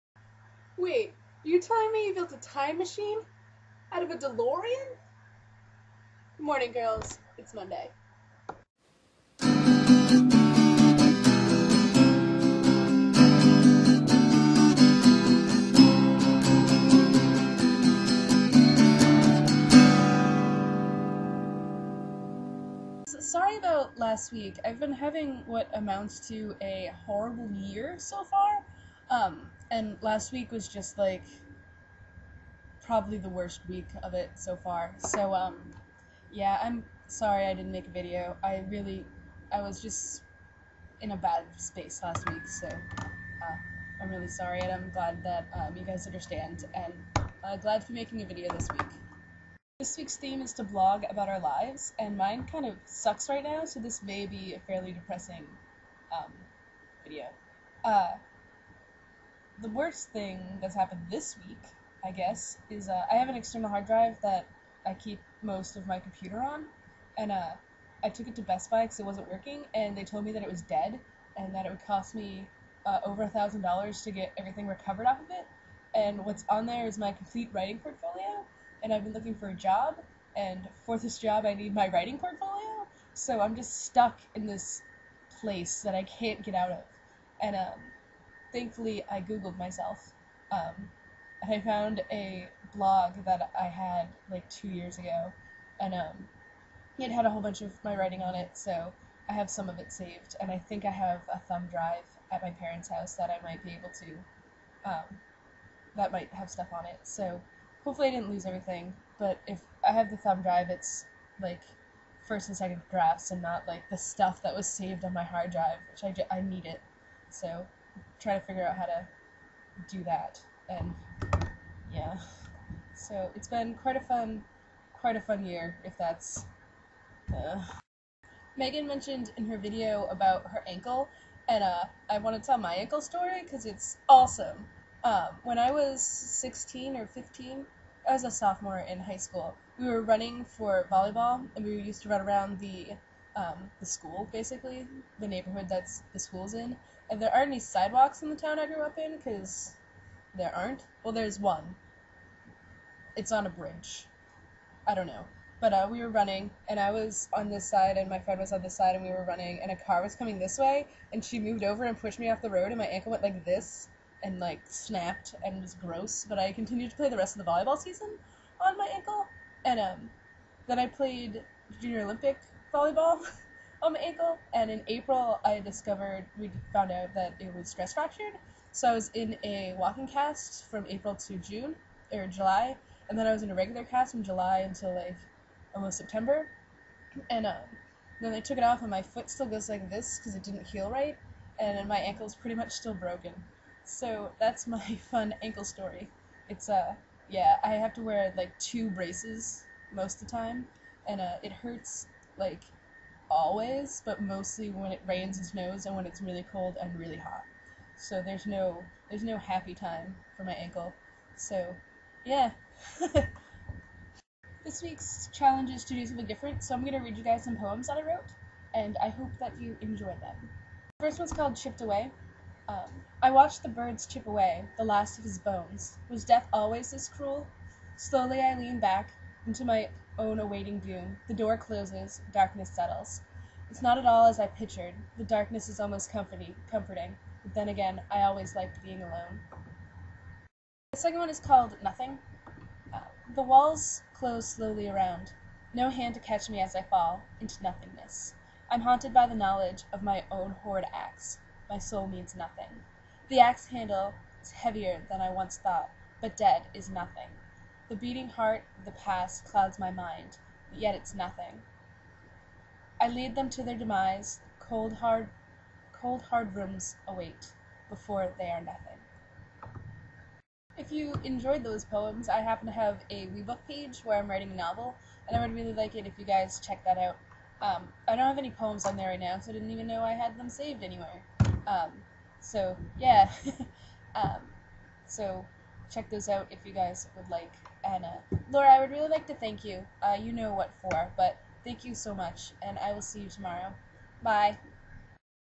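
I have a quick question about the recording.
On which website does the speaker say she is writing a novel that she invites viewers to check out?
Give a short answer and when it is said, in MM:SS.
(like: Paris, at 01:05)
WeBook, at 04:33.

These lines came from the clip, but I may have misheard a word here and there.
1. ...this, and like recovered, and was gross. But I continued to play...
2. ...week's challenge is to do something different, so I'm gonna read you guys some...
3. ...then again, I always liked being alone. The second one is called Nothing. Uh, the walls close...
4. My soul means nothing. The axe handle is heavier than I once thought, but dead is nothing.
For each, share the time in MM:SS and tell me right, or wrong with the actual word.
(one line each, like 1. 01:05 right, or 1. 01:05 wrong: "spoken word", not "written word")
1. 02:43 wrong: "snapped", not "recovered"
2. 03:34 right
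3. 03:57 right
4. 04:11 right.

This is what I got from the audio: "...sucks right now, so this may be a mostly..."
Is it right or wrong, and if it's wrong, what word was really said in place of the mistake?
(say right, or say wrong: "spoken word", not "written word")
wrong: "fairly", not "mostly".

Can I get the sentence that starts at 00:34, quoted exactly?
So um, yeah, I'm sorry I didn't make a video.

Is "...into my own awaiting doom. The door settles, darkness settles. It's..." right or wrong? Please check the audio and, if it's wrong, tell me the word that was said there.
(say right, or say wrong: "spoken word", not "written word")
wrong: "closes", not "settles".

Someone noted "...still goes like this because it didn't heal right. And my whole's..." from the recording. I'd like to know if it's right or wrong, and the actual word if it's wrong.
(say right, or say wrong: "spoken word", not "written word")
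wrong: "ankle", not "whole".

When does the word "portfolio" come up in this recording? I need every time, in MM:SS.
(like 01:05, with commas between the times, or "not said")
01:17, 01:22.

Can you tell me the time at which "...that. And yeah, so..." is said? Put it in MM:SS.
02:00.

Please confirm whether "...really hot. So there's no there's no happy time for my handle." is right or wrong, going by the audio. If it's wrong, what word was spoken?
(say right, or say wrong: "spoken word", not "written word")
wrong: "ankle", not "handle".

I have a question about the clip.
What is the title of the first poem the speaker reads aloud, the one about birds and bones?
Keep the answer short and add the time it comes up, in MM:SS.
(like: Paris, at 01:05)
Chipped Away, at 03:41.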